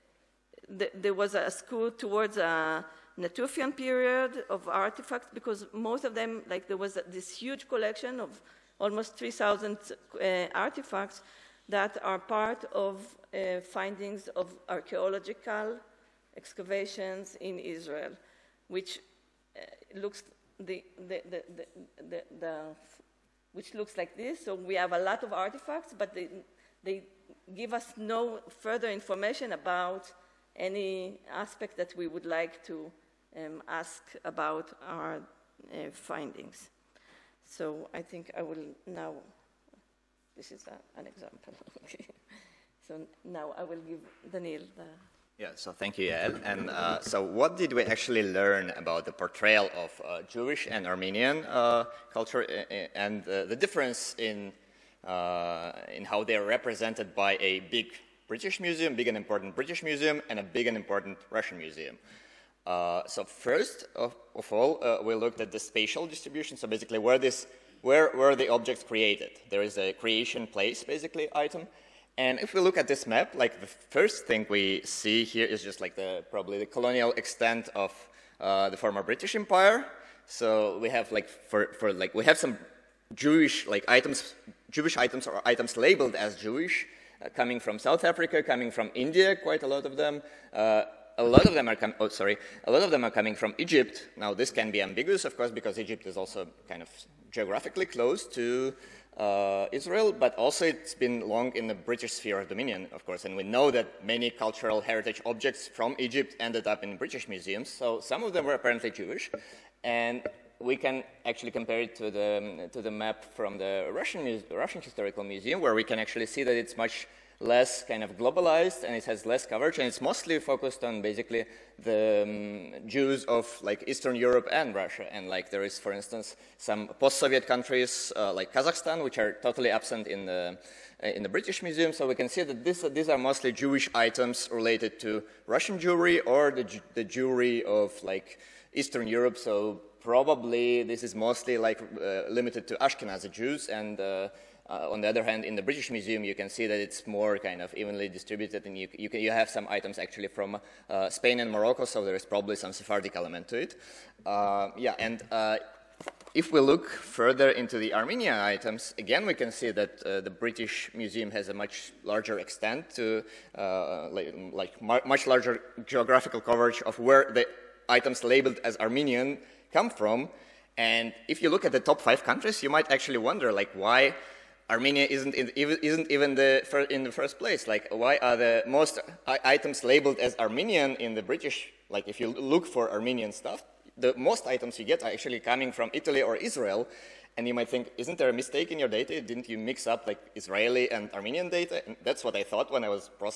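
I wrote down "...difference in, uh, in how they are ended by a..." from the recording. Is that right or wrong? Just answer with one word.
wrong.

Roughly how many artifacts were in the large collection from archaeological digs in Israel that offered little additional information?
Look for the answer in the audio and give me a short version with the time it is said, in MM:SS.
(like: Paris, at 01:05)
3,000, at 00:09.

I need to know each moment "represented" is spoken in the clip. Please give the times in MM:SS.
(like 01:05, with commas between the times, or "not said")
00:56.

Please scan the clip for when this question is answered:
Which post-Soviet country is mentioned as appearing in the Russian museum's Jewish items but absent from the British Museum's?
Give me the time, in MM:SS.
02:08.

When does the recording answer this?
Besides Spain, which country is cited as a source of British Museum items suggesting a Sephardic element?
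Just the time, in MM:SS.
02:31.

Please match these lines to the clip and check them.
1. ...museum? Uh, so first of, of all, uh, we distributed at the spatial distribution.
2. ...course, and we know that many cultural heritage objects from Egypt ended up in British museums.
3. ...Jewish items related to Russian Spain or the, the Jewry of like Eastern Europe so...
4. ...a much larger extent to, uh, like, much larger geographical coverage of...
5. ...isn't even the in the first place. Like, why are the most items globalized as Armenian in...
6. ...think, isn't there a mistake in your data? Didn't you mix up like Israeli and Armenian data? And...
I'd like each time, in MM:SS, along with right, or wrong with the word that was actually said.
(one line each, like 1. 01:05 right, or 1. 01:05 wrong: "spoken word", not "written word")
1. 01:01 wrong: "looked", not "distributed"
2. 01:43 right
3. 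02:13 wrong: "Jewry", not "Spain"
4. 02:41 right
5. 02:55 wrong: "labeled", not "globalized"
6. 03:07 right.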